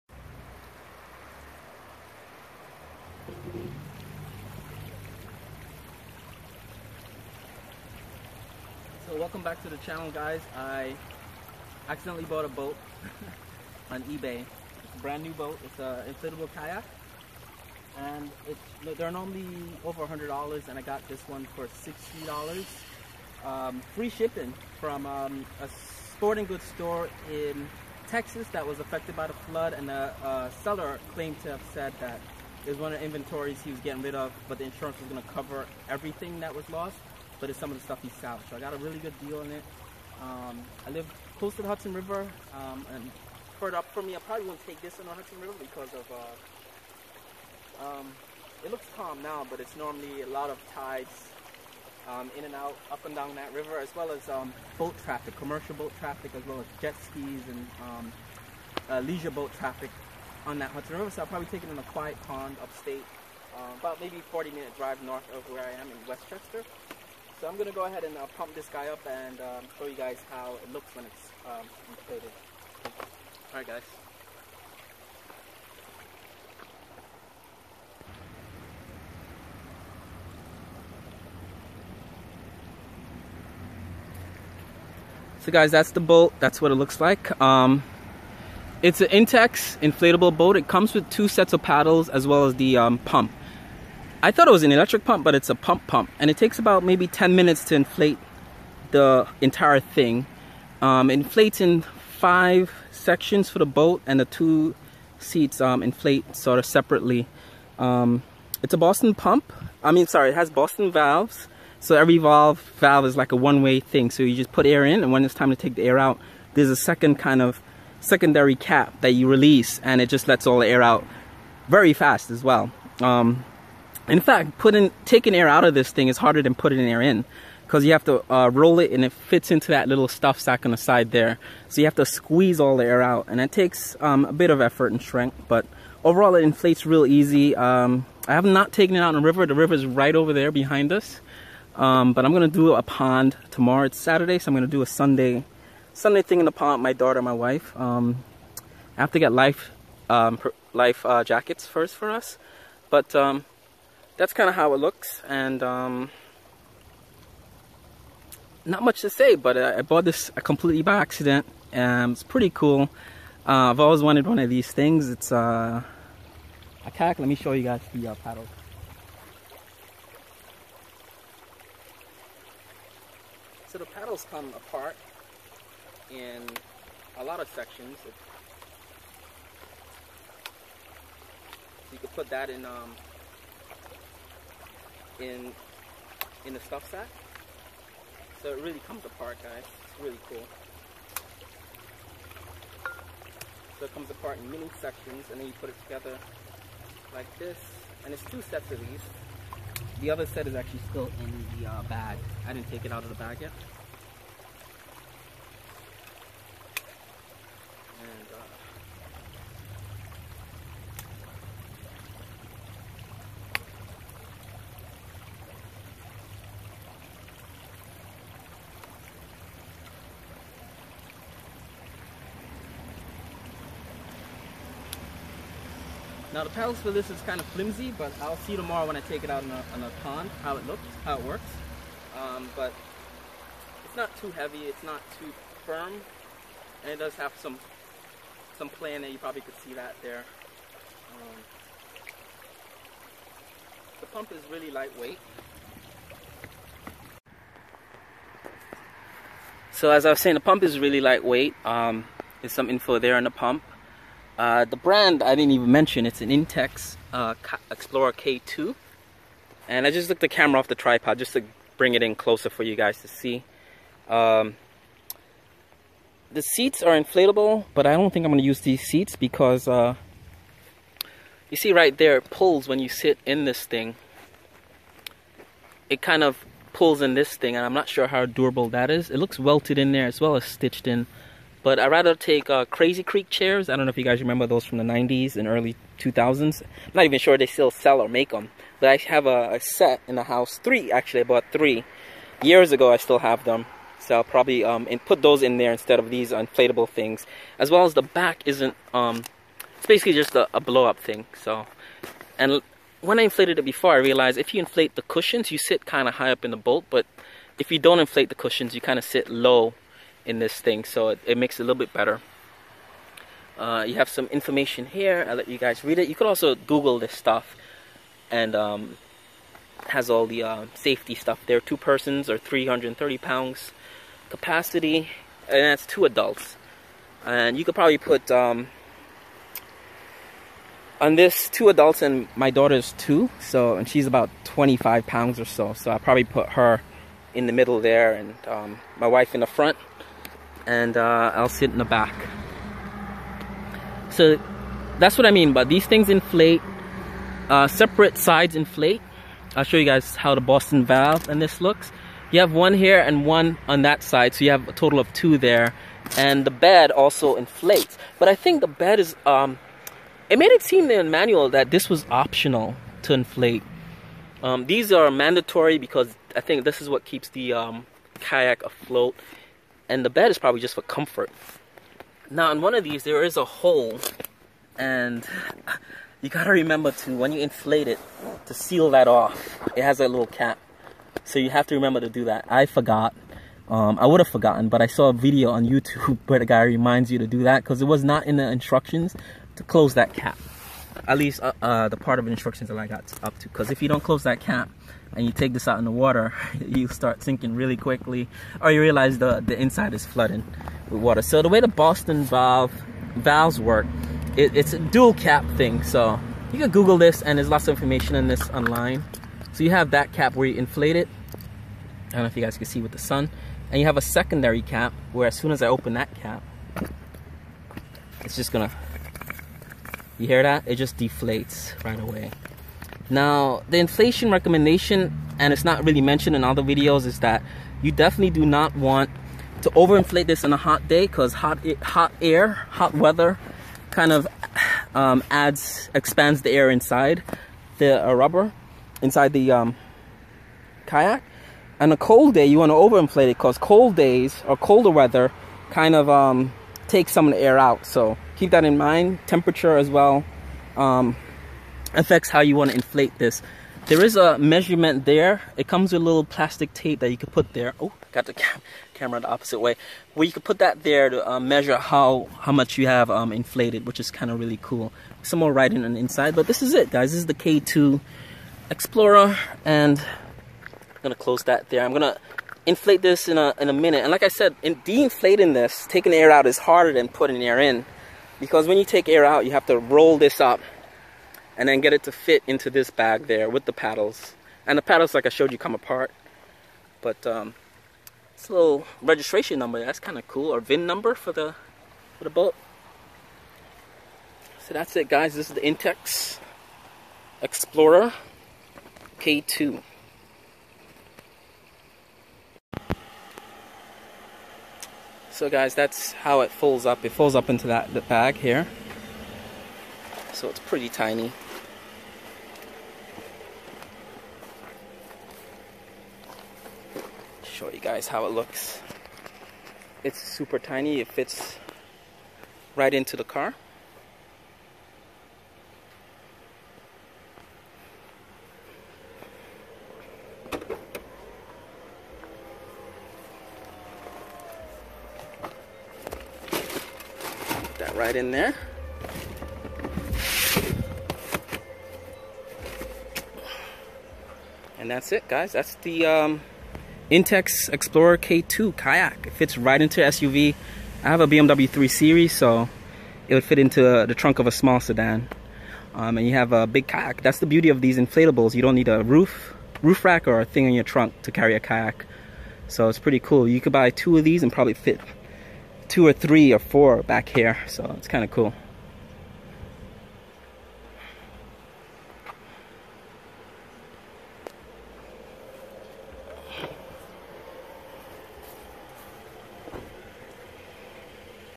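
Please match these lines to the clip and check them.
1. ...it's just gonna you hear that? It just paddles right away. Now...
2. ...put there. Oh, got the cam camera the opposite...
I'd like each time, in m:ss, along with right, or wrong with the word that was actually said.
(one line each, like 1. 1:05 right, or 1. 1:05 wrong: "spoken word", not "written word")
1. 6:58 wrong: "deflates", not "paddles"
2. 7:37 right.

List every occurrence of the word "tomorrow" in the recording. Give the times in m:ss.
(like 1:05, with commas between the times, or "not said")
2:23, 3:48.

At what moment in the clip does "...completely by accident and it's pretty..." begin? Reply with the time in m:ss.
2:40.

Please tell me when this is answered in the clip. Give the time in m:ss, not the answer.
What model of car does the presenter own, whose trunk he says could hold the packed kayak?
9:11.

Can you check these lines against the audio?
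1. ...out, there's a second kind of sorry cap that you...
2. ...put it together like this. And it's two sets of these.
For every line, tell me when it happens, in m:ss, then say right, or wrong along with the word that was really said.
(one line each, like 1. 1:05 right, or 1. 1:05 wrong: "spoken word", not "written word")
1. 1:55 wrong: "secondary", not "sorry"
2. 3:15 right.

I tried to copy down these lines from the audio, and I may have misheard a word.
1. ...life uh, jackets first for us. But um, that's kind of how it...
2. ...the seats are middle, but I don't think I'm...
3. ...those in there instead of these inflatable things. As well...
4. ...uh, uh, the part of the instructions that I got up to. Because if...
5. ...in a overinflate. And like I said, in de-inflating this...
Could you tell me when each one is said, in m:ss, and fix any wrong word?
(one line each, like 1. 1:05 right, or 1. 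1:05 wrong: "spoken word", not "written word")
1. 2:30 right
2. 4:26 wrong: "inflatable", not "middle"
3. 4:55 right
4. 6:31 right
5. 7:53 wrong: "minute", not "overinflate".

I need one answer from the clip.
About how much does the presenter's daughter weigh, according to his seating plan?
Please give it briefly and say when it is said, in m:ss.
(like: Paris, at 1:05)
25 pounds, at 5:34.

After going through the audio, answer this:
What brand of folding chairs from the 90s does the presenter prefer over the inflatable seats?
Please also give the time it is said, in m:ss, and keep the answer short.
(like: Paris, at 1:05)
Crazy Creek, at 4:42.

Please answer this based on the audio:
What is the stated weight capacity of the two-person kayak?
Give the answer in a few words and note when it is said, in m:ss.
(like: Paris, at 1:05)
330 pounds, at 5:22.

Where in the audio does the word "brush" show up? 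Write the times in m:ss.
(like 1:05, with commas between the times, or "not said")
not said.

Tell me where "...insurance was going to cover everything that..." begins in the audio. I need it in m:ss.
0:34.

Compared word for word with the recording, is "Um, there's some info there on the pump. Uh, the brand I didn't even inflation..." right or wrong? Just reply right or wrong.
wrong.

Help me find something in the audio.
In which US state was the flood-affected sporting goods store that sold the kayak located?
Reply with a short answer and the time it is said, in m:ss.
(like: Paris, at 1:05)
Texas, at 0:28.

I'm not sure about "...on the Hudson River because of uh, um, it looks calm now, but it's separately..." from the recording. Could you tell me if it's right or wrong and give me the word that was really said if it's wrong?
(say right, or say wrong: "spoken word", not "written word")
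wrong: "normally", not "separately".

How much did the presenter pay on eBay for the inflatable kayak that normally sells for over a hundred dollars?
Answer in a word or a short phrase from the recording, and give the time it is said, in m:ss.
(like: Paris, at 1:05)
$60, at 0:21.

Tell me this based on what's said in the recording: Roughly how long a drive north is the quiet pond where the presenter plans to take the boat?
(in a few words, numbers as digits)
40 minutes.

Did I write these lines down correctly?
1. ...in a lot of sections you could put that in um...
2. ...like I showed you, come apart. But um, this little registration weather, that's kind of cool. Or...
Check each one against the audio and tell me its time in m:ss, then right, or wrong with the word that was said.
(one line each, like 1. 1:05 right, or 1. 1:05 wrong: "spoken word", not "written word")
1. 2:56 right
2. 8:05 wrong: "number", not "weather".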